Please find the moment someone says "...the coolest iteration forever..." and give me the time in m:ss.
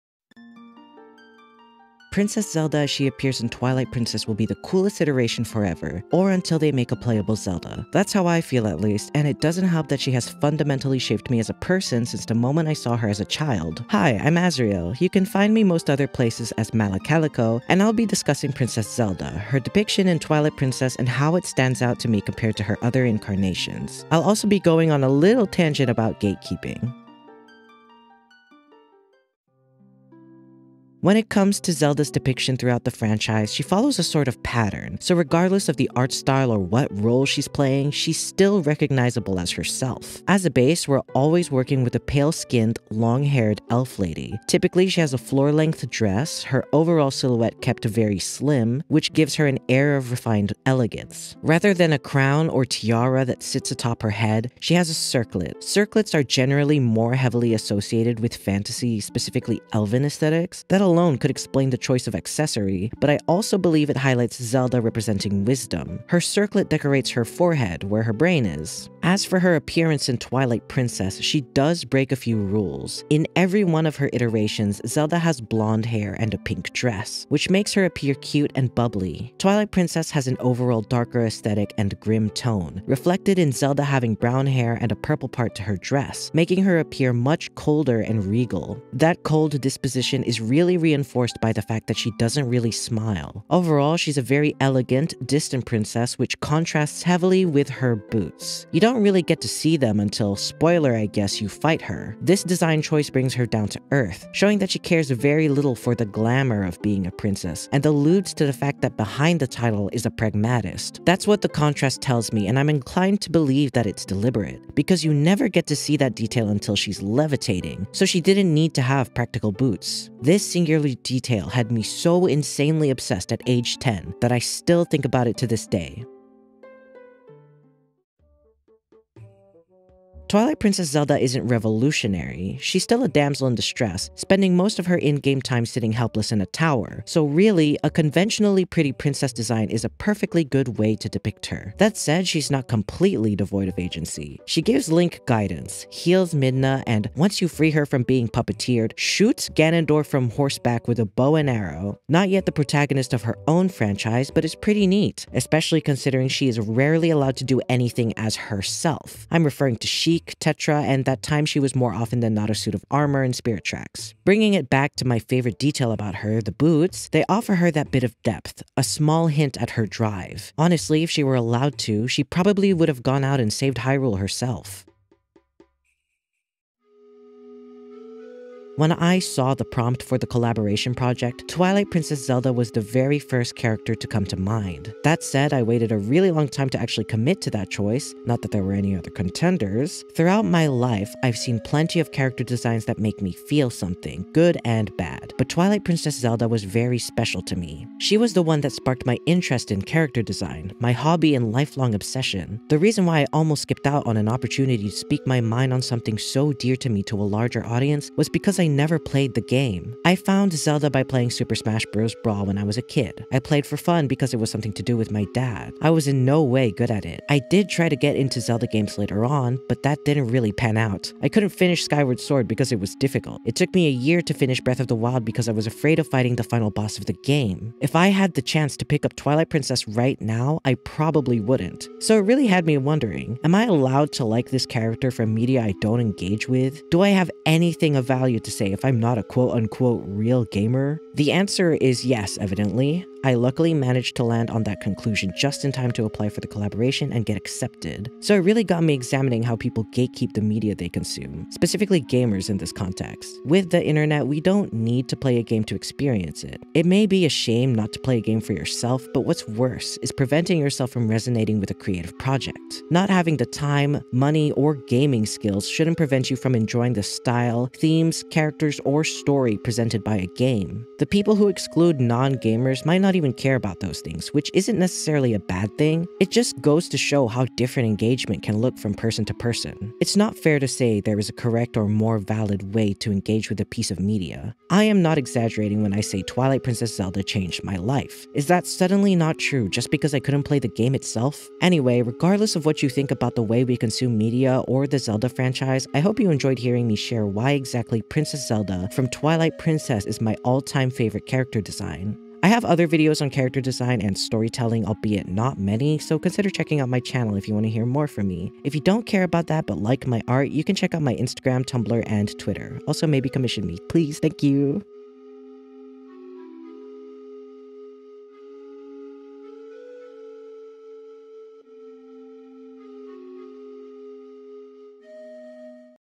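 0:04.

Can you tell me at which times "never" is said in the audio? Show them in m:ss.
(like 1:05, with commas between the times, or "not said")
1:55, 3:28.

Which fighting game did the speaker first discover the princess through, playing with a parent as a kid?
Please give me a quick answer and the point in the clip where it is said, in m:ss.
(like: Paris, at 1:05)
Super Smash Bros. Brawl, at 3:31.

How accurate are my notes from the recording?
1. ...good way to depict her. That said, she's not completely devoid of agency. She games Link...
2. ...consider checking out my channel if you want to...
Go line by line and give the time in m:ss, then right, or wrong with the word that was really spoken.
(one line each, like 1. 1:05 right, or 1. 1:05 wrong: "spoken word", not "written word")
1. 2:20 wrong: "gives", not "games"
2. 5:06 right.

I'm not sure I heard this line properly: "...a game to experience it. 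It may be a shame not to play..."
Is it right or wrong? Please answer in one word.
right.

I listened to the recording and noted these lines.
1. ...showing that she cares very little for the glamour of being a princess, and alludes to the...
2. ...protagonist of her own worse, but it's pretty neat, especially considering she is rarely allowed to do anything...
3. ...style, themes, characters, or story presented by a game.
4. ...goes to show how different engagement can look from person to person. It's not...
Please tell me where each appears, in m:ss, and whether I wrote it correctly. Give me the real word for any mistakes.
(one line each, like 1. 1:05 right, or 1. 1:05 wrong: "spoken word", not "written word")
1. 1:44 right
2. 2:32 wrong: "franchise", not "worse"
3. 4:27 right
4. 4:36 right.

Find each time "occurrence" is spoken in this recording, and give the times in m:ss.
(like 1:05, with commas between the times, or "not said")
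not said.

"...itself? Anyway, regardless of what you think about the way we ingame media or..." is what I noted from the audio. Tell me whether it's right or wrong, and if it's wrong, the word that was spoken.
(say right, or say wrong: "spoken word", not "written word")
wrong: "consume", not "ingame".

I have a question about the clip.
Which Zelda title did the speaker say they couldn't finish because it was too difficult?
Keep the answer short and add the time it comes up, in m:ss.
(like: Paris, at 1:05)
Skyward Sword, at 3:41.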